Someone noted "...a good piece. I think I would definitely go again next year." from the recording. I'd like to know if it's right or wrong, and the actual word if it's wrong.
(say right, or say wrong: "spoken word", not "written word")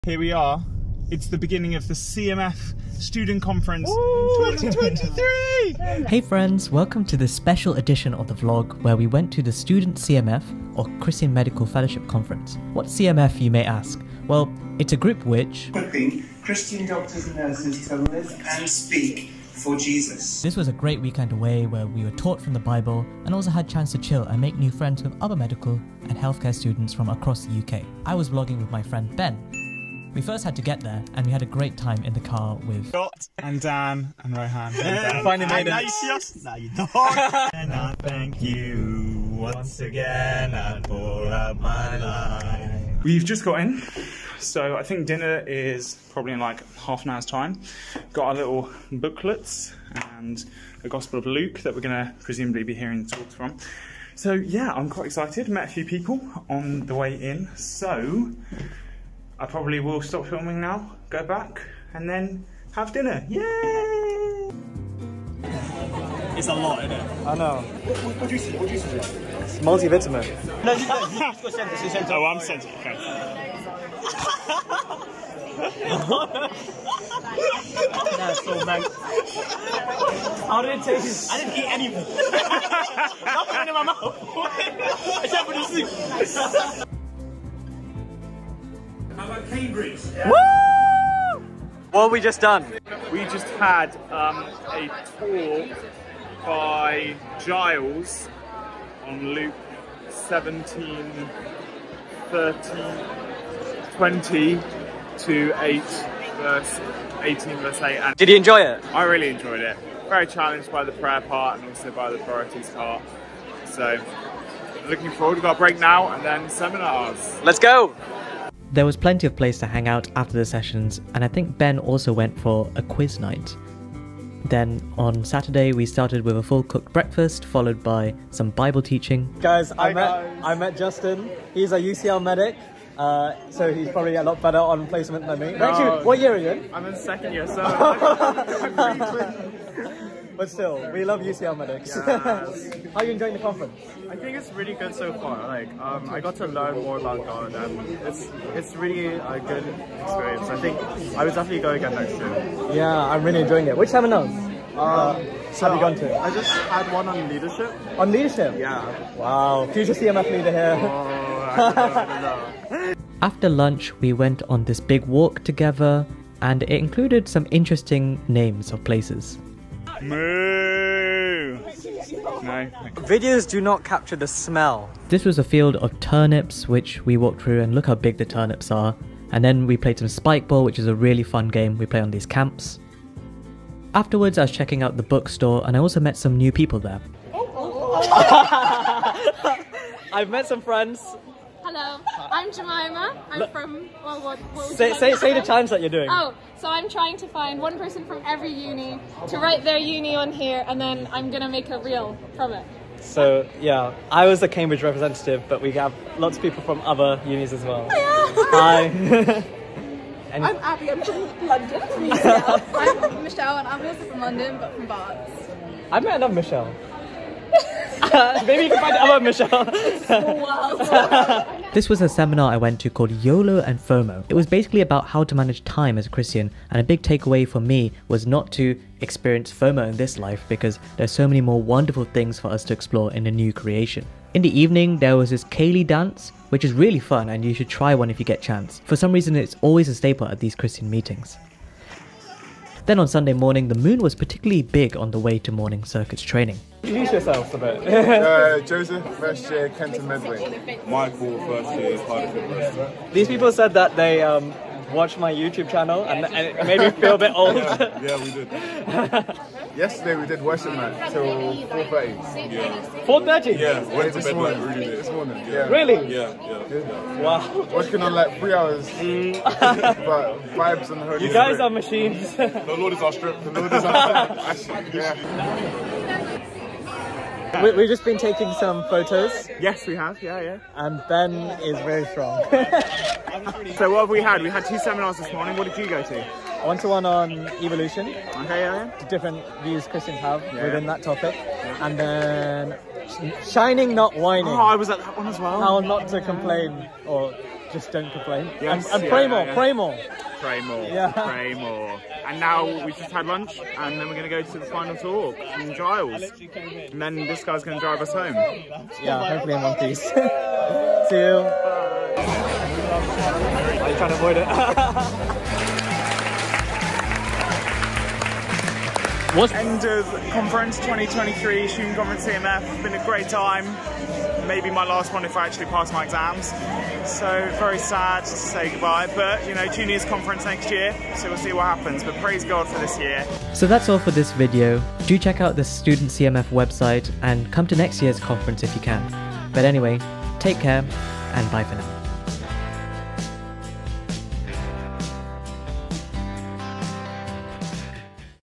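wrong: "experience", not "piece".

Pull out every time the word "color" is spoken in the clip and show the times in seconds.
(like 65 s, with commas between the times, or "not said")
not said.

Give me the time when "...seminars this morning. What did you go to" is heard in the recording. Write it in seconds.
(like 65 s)
284 s.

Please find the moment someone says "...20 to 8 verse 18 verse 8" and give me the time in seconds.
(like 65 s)
103 s.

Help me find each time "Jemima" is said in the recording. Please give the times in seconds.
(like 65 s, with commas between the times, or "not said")
192 s.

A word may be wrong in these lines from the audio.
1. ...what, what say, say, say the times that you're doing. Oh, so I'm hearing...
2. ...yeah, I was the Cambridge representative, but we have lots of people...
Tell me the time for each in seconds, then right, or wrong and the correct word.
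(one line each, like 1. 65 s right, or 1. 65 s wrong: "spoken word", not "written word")
1. 194 s wrong: "trying", not "hearing"
2. 203 s right.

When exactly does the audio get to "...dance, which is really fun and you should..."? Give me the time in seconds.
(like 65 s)
235 s.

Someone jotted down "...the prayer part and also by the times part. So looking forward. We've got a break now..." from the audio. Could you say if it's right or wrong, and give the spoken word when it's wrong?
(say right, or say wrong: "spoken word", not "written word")
wrong: "priorities", not "times".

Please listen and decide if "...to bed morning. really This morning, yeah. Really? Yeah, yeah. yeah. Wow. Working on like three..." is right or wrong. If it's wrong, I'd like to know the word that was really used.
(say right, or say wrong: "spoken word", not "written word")
right.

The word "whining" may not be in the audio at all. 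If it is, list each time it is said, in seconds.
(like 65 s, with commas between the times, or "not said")
294 s.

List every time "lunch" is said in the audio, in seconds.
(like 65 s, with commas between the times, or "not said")
163 s, 303 s.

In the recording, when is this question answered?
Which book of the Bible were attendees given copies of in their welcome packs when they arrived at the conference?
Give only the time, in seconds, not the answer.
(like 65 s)
50 s.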